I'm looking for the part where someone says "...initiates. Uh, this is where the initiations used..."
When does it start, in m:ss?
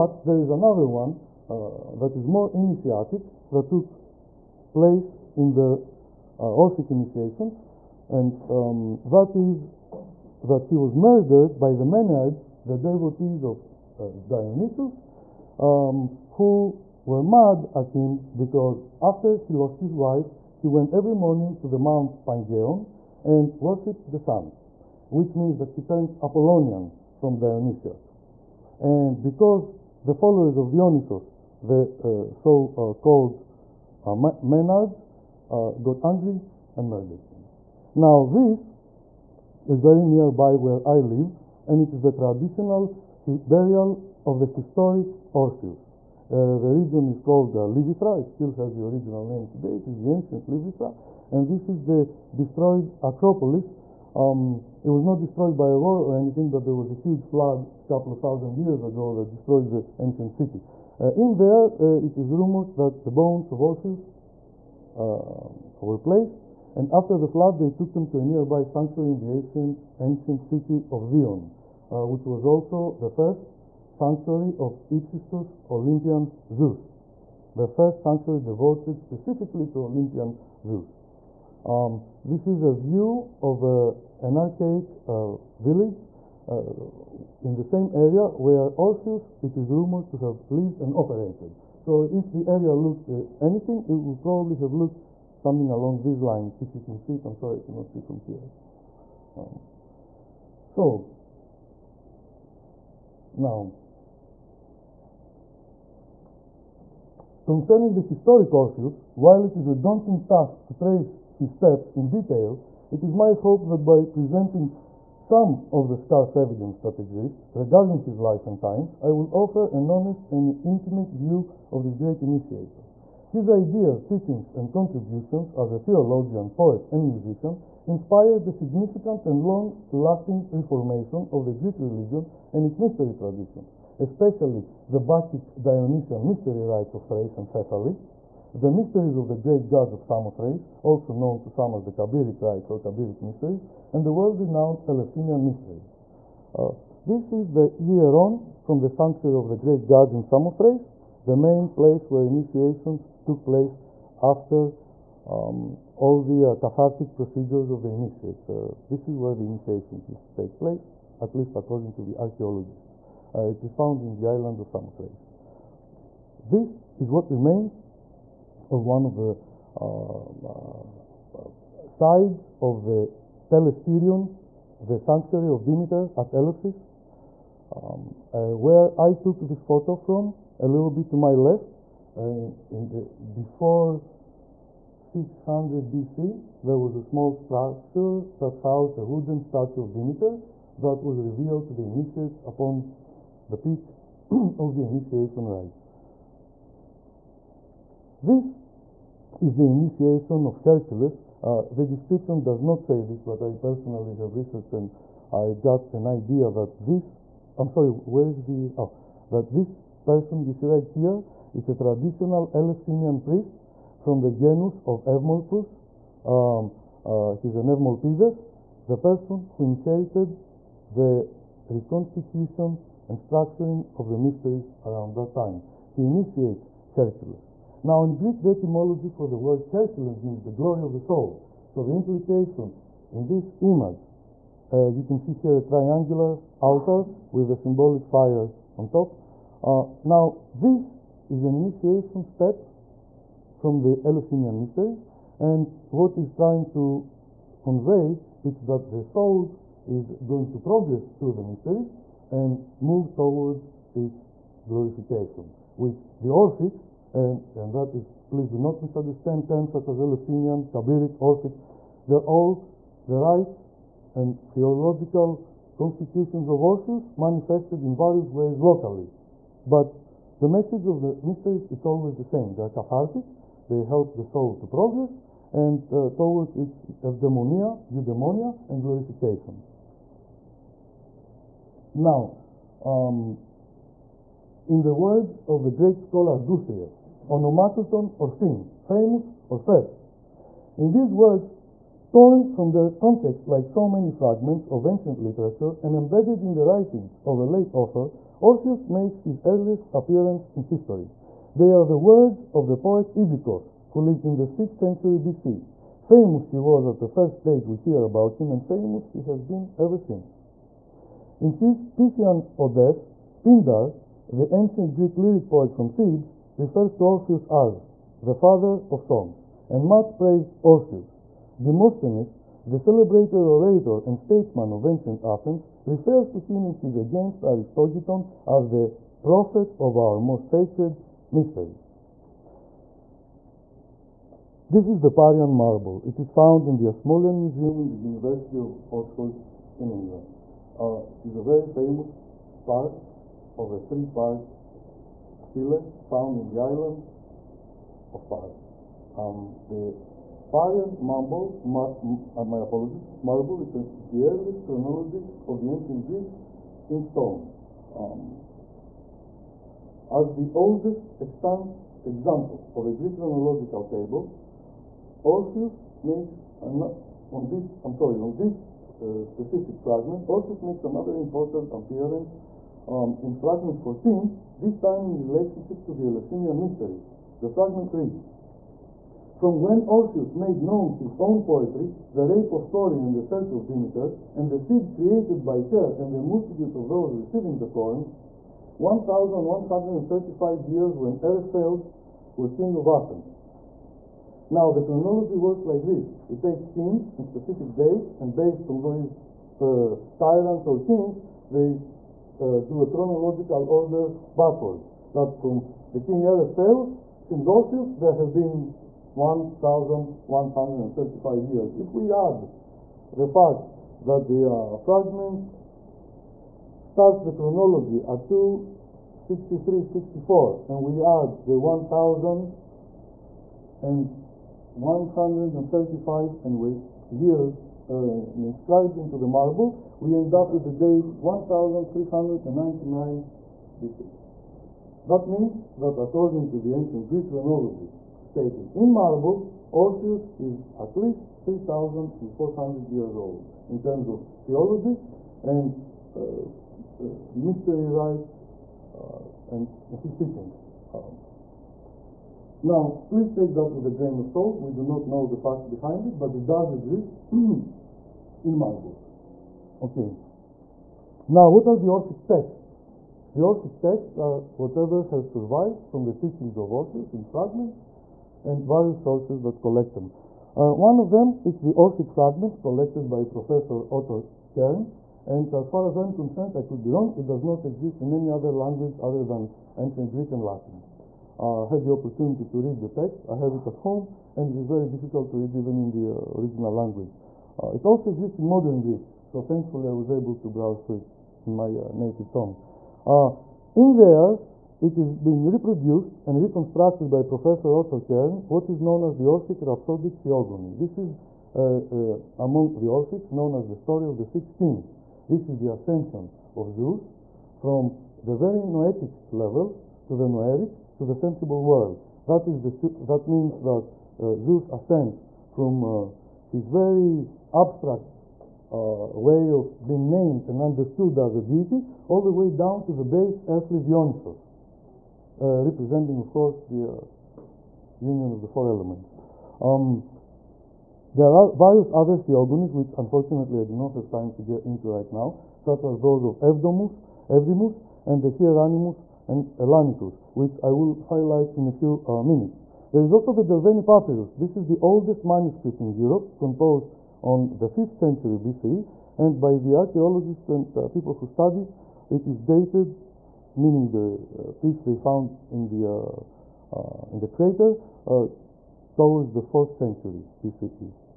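2:37.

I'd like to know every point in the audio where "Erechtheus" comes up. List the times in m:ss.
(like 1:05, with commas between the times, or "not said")
6:31, 6:46.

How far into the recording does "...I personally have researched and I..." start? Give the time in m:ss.
3:23.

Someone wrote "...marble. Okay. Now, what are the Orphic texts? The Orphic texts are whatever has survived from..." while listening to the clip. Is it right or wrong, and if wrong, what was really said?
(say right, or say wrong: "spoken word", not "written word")
right.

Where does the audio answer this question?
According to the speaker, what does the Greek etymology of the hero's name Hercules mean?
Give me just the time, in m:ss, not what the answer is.
3:50.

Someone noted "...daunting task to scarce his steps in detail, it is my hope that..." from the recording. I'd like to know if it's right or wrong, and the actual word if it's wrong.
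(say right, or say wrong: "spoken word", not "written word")
wrong: "trace", not "scarce".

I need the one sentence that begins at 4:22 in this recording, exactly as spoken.
They're all the rites and theological constitutions of Orpheus manifested in various ways locally.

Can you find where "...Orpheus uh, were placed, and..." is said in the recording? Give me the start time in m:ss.
1:03.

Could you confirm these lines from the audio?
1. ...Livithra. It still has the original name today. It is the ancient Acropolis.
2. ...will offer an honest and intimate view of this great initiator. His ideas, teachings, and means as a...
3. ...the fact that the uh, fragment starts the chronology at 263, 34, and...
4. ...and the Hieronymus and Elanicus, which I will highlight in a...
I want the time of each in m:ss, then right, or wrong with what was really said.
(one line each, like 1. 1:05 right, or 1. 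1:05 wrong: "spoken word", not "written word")
1. 0:47 wrong: "Livithra", not "Acropolis"
2. 1:59 wrong: "contributions", not "means"
3. 6:53 wrong: "64", not "34"
4. 8:58 right.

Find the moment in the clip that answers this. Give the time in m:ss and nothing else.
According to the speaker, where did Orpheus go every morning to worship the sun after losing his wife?
0:21.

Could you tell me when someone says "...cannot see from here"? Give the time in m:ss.
1:37.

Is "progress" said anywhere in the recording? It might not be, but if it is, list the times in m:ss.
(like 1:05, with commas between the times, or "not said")
4:10, 4:34.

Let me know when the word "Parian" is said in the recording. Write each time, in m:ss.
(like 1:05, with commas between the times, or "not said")
5:35, 5:50.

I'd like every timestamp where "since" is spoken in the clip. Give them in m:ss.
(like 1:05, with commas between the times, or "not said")
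5:09, 6:47.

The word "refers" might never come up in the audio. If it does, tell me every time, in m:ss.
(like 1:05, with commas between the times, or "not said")
5:16, 5:25.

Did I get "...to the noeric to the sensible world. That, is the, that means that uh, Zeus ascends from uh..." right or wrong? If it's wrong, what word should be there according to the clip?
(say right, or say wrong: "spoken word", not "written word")
right.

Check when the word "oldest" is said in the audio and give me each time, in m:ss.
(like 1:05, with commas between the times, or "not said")
6:00, 9:04.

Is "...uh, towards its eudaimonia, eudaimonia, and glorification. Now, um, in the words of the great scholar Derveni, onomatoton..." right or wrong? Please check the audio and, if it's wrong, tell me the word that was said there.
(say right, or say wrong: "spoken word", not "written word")
wrong: "Guthrie", not "Derveni".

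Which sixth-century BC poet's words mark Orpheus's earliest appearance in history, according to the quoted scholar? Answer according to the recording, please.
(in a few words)
Ibikos.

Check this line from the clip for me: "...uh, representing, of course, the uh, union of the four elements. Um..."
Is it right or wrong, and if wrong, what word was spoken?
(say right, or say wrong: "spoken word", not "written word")
right.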